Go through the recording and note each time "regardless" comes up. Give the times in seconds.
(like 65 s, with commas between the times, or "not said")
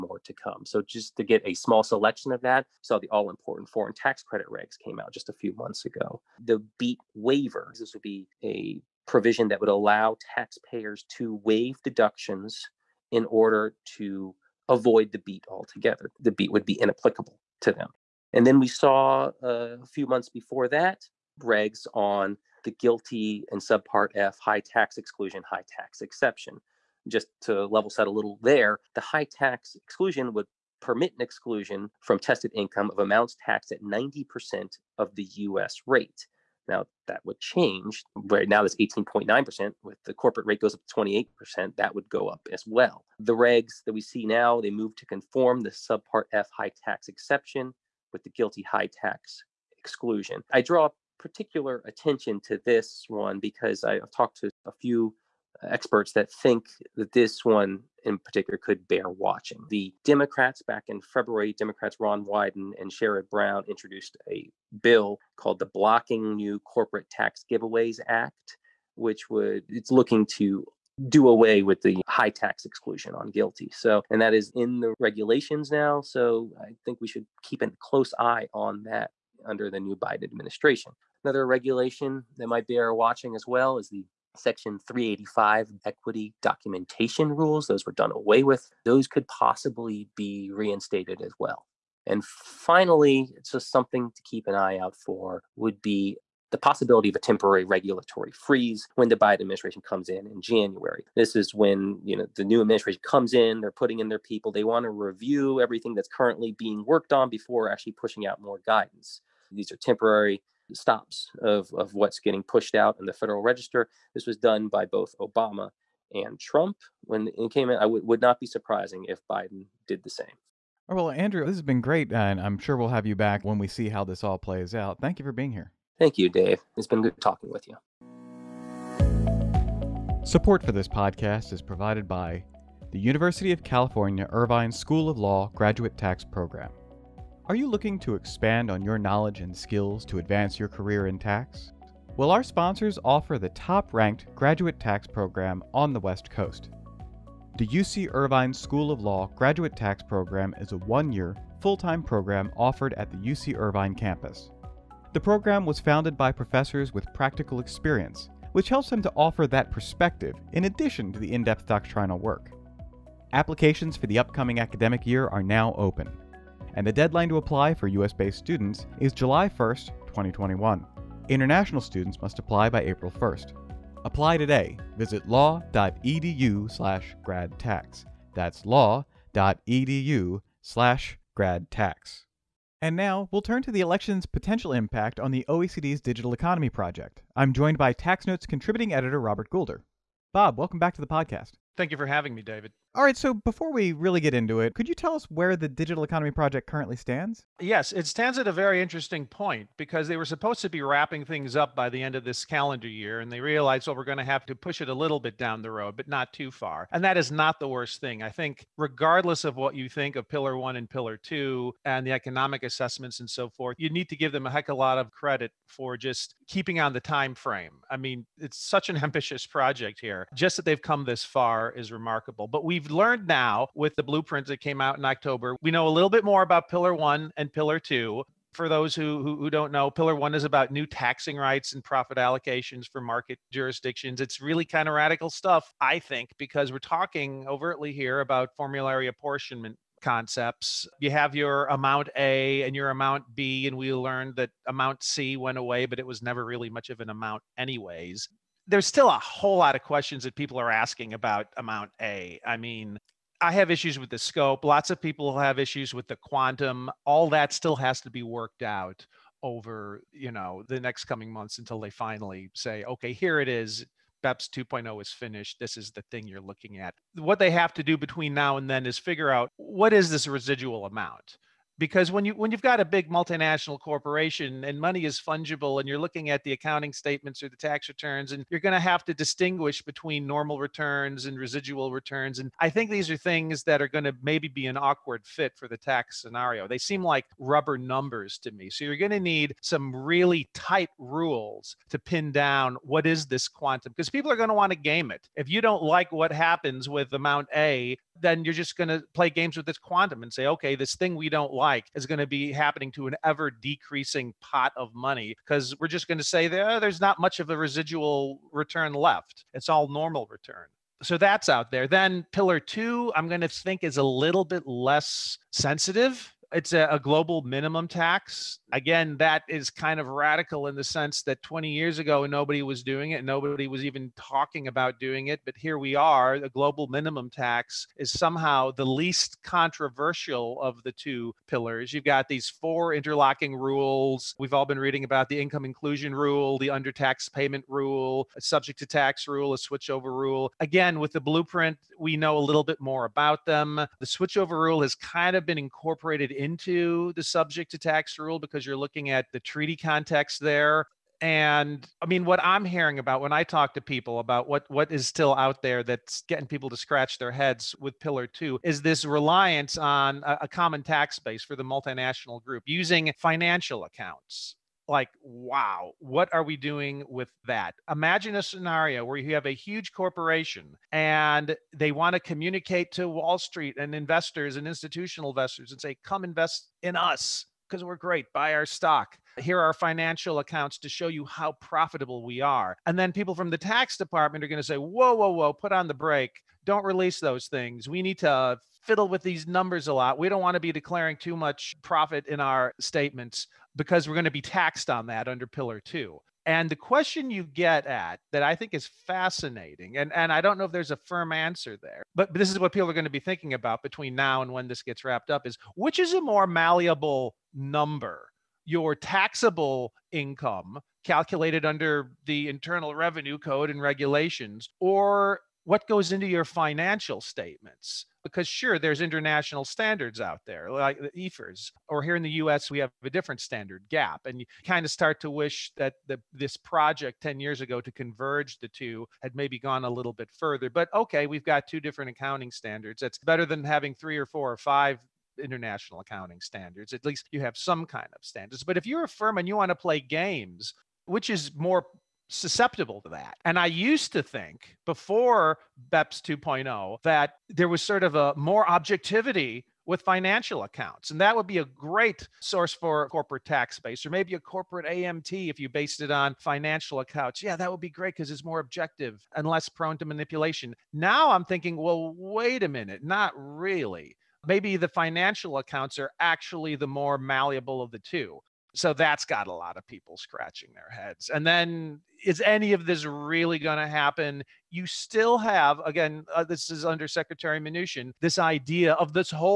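208 s.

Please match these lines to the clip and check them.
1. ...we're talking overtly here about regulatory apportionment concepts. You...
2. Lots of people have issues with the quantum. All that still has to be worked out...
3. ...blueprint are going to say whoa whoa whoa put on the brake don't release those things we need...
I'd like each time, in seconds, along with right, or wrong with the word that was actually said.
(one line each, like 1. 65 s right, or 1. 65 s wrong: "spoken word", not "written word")
1. 236 s wrong: "formulary", not "regulatory"
2. 254 s right
3. 383 s wrong: "department", not "blueprint".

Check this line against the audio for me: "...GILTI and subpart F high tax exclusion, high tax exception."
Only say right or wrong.
right.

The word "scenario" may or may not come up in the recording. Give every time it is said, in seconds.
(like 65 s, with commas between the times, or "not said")
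286 s, 368 s.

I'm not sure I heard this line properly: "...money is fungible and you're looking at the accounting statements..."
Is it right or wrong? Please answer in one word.
right.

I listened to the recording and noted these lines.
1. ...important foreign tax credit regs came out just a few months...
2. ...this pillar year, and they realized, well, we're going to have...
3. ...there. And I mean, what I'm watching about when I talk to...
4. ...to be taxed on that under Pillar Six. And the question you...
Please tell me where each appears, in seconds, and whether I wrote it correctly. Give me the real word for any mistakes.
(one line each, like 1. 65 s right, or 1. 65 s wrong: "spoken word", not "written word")
1. 3 s right
2. 202 s wrong: "calendar", not "pillar"
3. 350 s wrong: "hearing", not "watching"
4. 394 s wrong: "Two", not "Six".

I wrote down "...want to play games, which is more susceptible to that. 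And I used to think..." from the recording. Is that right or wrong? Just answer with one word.
right.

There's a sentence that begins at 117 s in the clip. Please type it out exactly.
I w- would not be surprising if Biden did the same.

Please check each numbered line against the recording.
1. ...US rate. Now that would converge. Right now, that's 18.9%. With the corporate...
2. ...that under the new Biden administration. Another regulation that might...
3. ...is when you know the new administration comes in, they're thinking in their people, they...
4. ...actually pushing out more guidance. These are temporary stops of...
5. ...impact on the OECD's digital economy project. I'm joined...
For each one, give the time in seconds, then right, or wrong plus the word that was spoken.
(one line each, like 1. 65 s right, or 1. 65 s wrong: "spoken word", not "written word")
1. 35 s wrong: "change", not "converge"
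2. 78 s right
3. 101 s wrong: "putting", not "thinking"
4. 107 s right
5. 184 s right.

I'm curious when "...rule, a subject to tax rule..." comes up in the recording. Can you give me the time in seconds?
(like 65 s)
337 s.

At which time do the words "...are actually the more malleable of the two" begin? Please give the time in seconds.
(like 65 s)
465 s.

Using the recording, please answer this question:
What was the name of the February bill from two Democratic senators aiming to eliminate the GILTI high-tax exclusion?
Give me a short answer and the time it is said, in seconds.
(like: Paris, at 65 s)
Blocking New Corporate Tax Giveaways Act, at 65 s.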